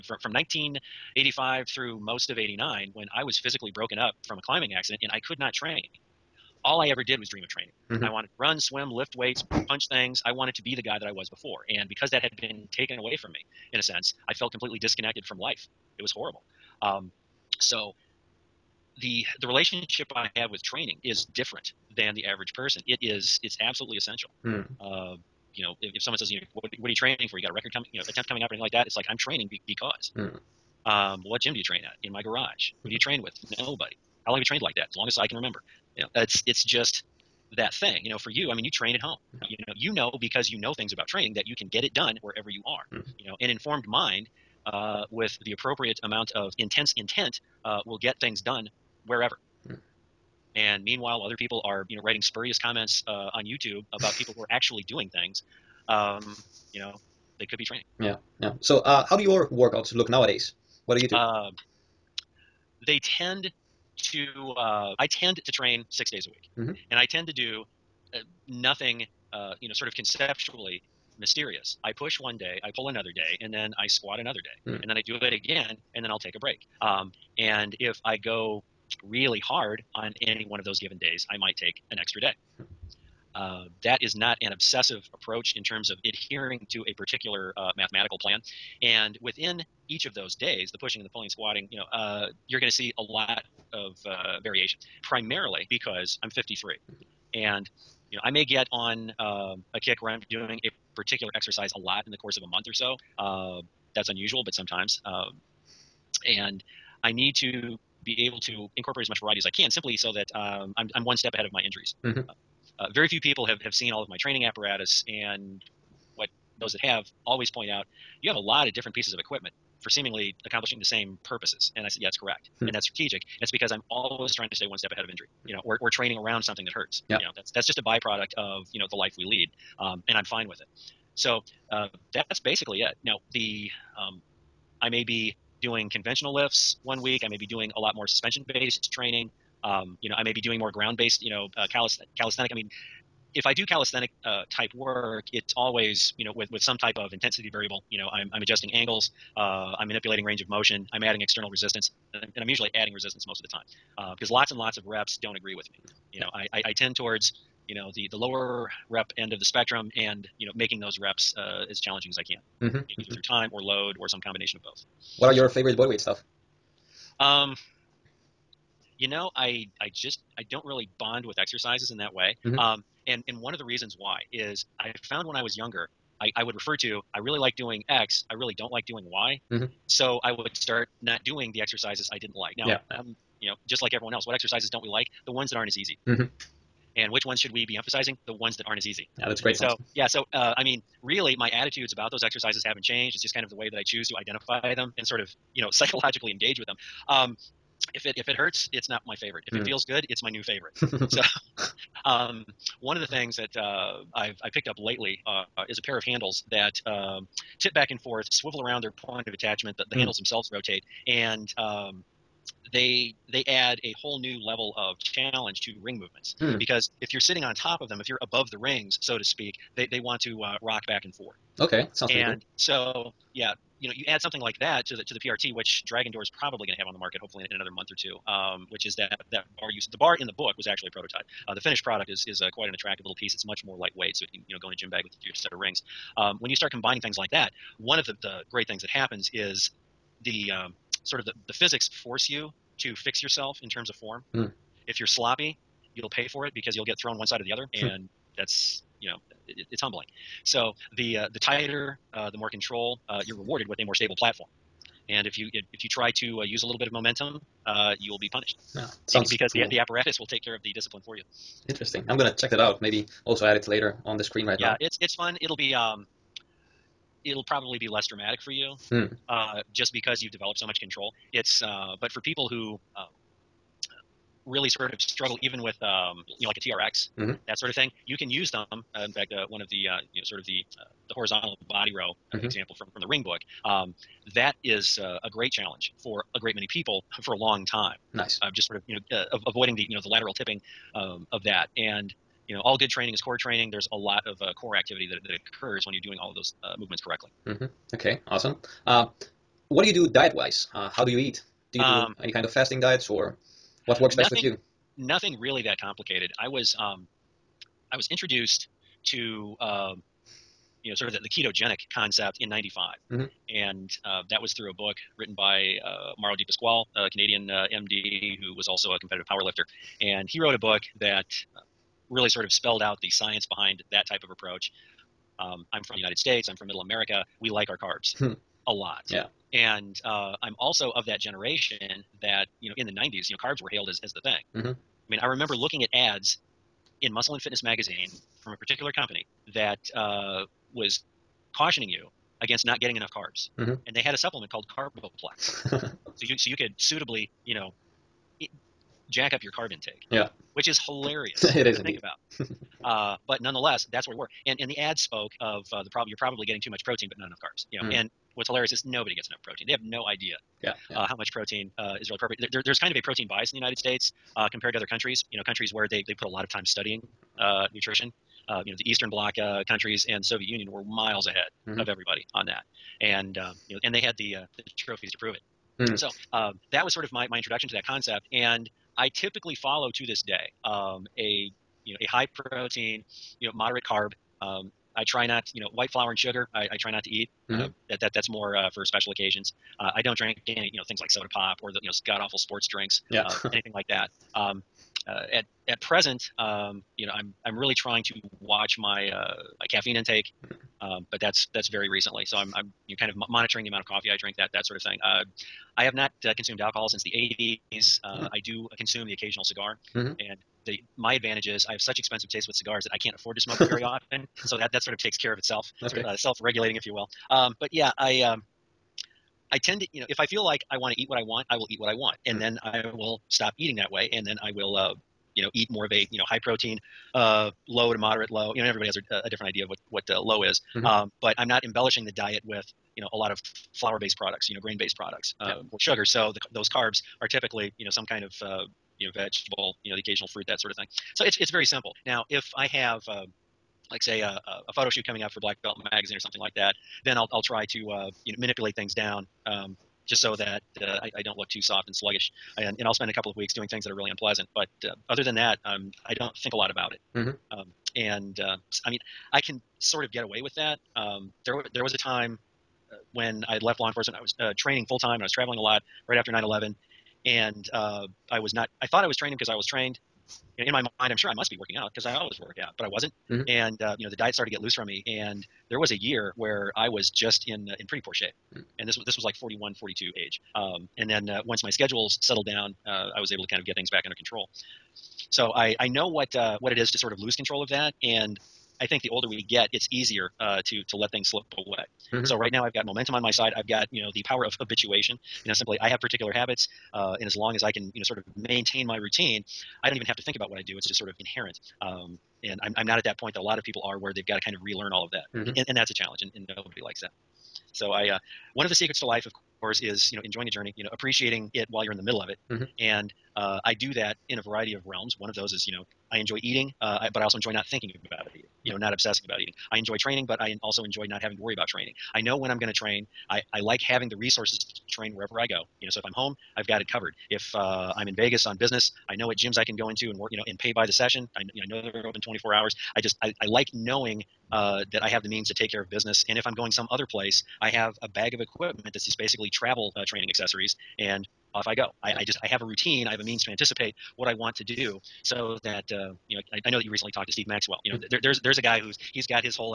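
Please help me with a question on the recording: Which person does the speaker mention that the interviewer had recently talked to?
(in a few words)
Steve Maxwell.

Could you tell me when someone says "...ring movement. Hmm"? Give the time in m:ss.
3:35.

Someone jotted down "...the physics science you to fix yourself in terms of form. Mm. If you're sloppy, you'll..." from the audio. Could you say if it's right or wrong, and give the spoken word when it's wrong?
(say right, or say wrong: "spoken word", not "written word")
wrong: "force", not "science".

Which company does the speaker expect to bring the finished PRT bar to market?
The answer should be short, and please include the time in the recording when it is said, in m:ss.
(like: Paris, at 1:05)
Dragon Door, at 3:45.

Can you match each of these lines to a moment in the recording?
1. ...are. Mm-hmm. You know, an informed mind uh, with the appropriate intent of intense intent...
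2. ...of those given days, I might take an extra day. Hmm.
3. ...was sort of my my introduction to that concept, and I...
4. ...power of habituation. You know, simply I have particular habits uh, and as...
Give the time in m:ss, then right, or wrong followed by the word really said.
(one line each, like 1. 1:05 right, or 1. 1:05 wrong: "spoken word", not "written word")
1. 0:42 wrong: "amount", not "intent"
2. 1:20 right
3. 6:16 right
4. 8:14 right.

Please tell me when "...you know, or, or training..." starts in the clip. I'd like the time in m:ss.
2:05.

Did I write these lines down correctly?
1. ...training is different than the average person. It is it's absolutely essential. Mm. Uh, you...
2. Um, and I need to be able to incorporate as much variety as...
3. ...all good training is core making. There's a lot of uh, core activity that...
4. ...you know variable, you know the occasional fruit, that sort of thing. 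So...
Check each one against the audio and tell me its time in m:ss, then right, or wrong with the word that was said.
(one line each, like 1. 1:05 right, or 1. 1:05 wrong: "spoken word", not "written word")
1. 0:20 right
2. 1:45 right
3. 4:52 wrong: "training", not "making"
4. 7:18 wrong: "vegetable", not "variable".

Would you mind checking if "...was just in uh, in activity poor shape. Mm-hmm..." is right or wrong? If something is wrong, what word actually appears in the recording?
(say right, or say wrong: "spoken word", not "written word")
wrong: "pretty", not "activity".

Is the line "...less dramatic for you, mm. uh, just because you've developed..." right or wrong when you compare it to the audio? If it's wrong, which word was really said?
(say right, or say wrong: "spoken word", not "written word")
right.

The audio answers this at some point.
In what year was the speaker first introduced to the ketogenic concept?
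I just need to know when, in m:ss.
5:12.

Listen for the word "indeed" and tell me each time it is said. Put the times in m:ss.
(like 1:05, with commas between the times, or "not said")
5:51.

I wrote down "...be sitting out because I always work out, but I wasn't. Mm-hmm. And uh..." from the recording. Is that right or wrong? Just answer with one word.
wrong.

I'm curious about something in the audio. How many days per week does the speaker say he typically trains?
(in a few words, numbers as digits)
6.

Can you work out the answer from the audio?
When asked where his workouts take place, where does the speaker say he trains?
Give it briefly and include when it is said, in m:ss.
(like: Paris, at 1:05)
In my garage, at 0:32.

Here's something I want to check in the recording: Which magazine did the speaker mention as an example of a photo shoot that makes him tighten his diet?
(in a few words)
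Black Belt Magazine.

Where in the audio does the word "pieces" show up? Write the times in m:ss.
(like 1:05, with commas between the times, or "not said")
1:58, 3:53.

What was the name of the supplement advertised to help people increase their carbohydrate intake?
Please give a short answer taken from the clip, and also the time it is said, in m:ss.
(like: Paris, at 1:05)
Carboplex, at 5:44.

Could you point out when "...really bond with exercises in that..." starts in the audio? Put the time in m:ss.
2:50.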